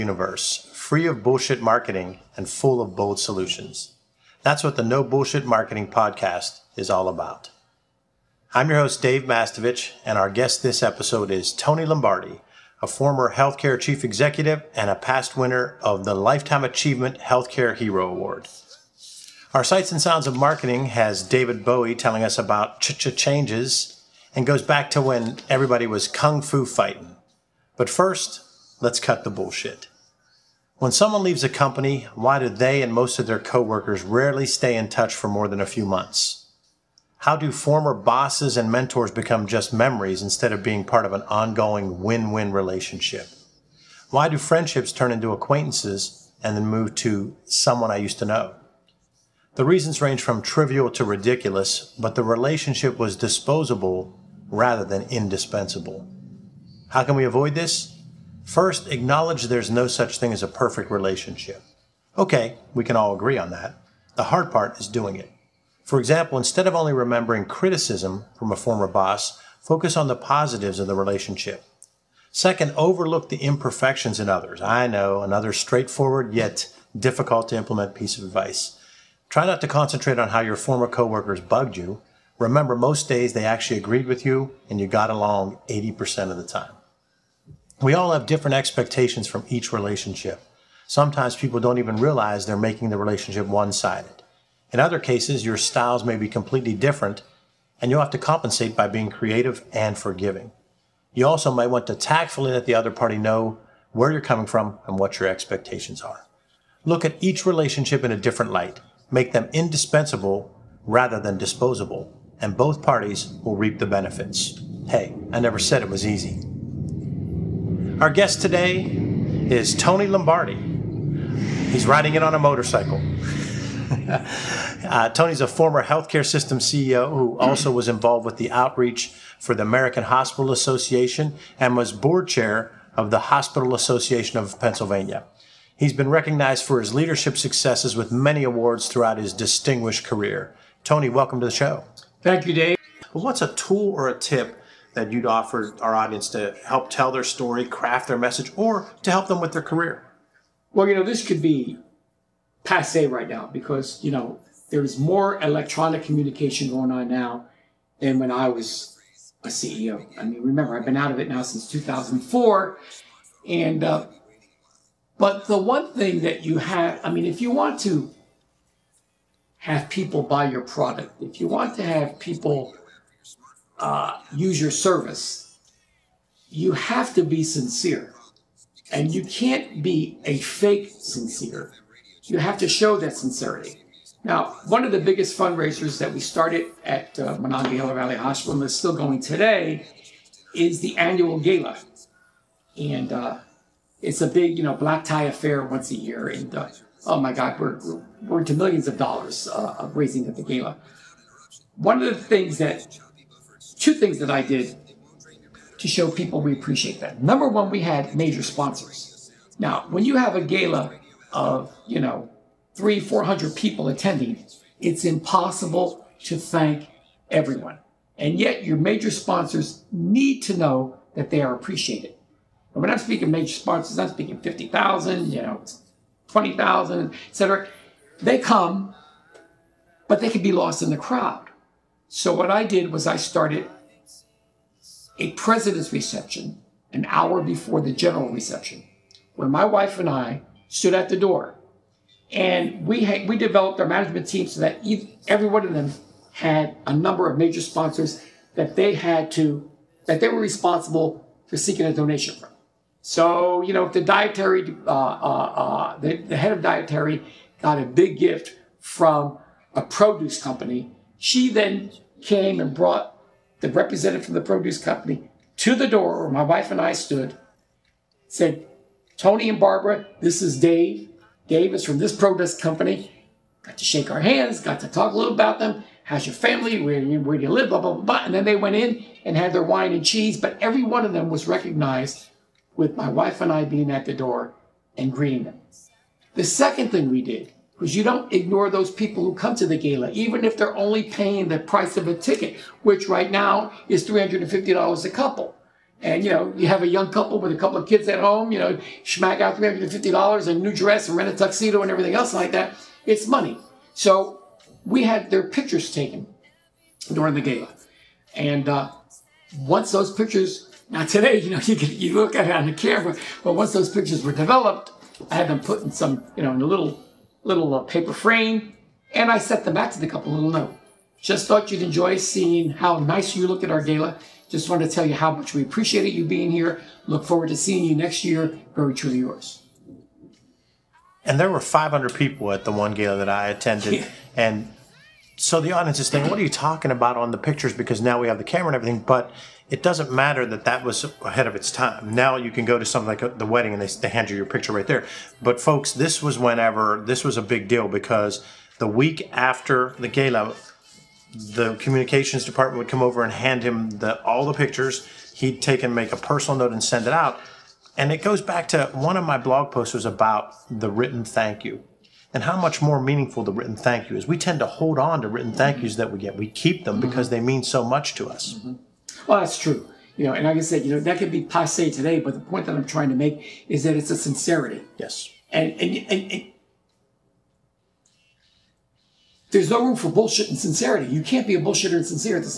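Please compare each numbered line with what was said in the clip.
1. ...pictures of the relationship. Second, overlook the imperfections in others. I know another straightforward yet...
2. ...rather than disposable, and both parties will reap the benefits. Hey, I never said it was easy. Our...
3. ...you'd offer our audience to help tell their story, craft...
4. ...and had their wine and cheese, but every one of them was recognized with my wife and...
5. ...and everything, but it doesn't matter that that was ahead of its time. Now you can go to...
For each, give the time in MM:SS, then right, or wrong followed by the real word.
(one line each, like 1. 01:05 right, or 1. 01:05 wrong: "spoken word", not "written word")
1. 01:10 wrong: "positives", not "pictures"
2. 01:50 right
3. 02:25 right
4. 04:39 right
5. 05:38 right.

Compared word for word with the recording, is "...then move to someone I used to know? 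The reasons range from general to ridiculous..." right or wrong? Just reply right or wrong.
wrong.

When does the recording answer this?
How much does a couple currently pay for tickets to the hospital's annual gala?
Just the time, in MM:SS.
04:54.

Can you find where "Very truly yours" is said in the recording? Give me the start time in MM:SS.
05:28.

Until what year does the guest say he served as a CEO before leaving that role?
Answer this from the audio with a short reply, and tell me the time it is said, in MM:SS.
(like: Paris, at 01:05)
2004, at 02:41.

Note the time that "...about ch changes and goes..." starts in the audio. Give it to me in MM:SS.
00:22.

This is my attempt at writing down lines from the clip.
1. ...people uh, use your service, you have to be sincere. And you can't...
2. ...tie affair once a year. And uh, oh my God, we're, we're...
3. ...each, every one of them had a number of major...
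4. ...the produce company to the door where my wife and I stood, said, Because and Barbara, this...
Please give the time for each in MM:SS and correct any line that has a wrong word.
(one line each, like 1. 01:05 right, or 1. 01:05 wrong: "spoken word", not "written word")
1. 02:52 right
2. 03:15 right
3. 04:04 right
4. 04:24 wrong: "Tony", not "Because".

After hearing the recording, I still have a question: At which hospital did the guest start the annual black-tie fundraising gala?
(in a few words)
Monongahela Valley Hospital.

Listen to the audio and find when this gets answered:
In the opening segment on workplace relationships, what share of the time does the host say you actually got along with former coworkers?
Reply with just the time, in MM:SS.
01:25.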